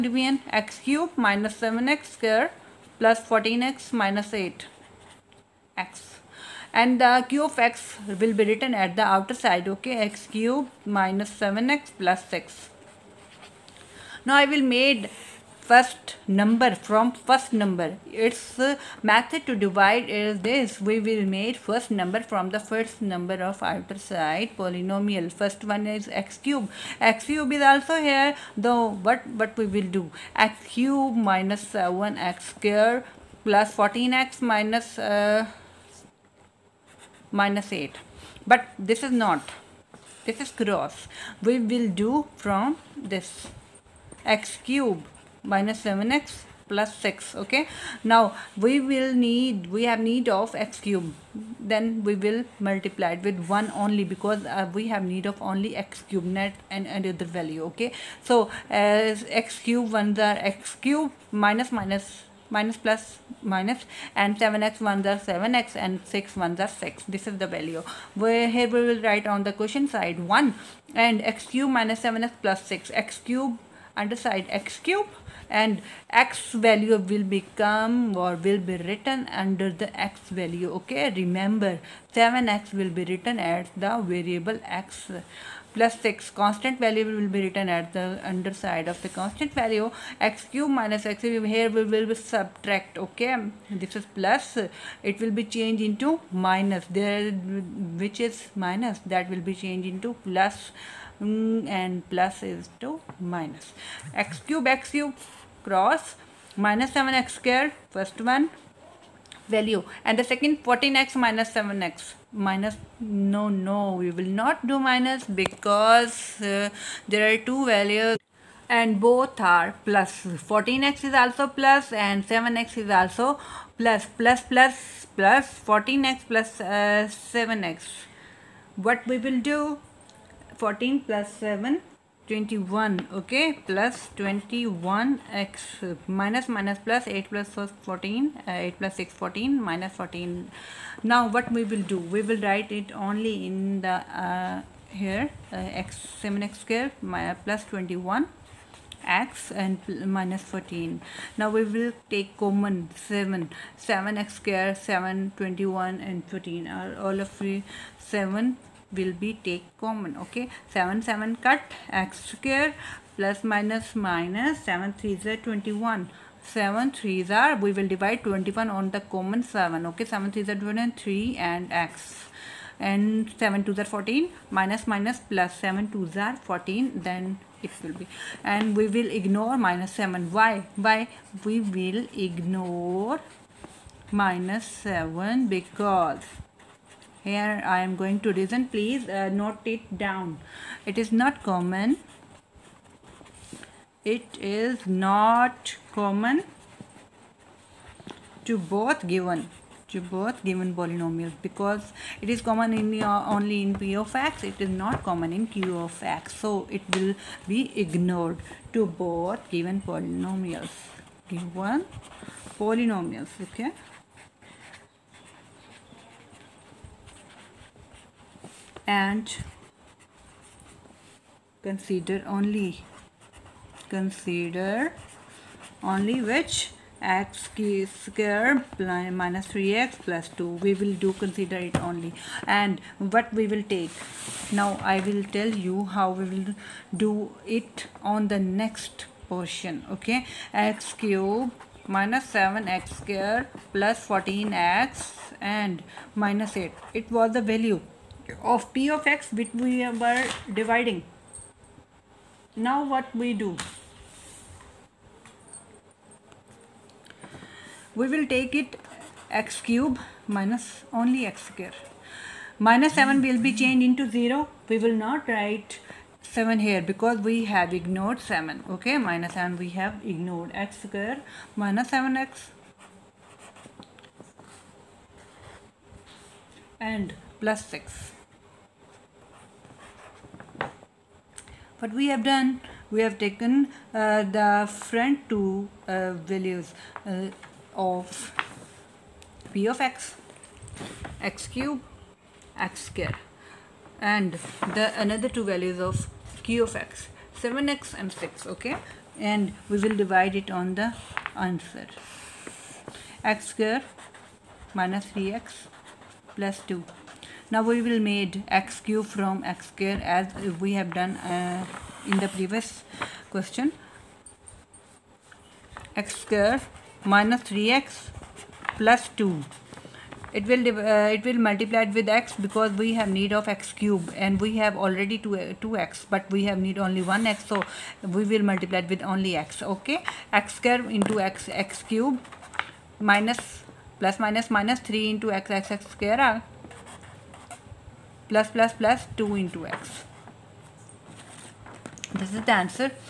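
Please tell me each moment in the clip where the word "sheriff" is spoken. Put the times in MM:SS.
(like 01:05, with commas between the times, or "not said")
not said.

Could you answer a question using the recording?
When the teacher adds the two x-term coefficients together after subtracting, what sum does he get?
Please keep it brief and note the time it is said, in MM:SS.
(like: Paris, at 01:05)
21, at 02:10.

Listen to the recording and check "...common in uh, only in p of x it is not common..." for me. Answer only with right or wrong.
right.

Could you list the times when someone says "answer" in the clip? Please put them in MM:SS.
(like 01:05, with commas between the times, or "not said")
05:01, 05:42.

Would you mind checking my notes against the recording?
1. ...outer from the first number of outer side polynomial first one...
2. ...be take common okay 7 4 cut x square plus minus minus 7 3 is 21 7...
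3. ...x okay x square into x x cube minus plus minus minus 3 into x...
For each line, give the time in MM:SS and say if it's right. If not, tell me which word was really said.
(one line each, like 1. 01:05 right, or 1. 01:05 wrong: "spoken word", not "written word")
1. 00:21 wrong: "number", not "outer"
2. 02:39 wrong: "7", not "4"
3. 05:29 right.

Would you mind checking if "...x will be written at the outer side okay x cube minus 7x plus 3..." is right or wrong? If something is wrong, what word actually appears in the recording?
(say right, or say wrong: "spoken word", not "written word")
wrong: "6", not "3".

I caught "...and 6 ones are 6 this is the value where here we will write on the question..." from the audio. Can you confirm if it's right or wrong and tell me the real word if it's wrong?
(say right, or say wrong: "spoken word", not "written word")
right.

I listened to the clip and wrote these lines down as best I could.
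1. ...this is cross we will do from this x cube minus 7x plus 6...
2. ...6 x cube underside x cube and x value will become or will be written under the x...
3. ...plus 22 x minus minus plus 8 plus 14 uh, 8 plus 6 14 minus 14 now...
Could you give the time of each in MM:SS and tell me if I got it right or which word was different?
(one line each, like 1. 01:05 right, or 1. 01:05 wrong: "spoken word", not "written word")
1. 00:40 right
2. 01:12 right
3. 02:13 wrong: "21", not "22".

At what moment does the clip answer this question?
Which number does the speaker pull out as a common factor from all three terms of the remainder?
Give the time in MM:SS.
02:31.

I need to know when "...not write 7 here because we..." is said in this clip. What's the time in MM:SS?
04:24.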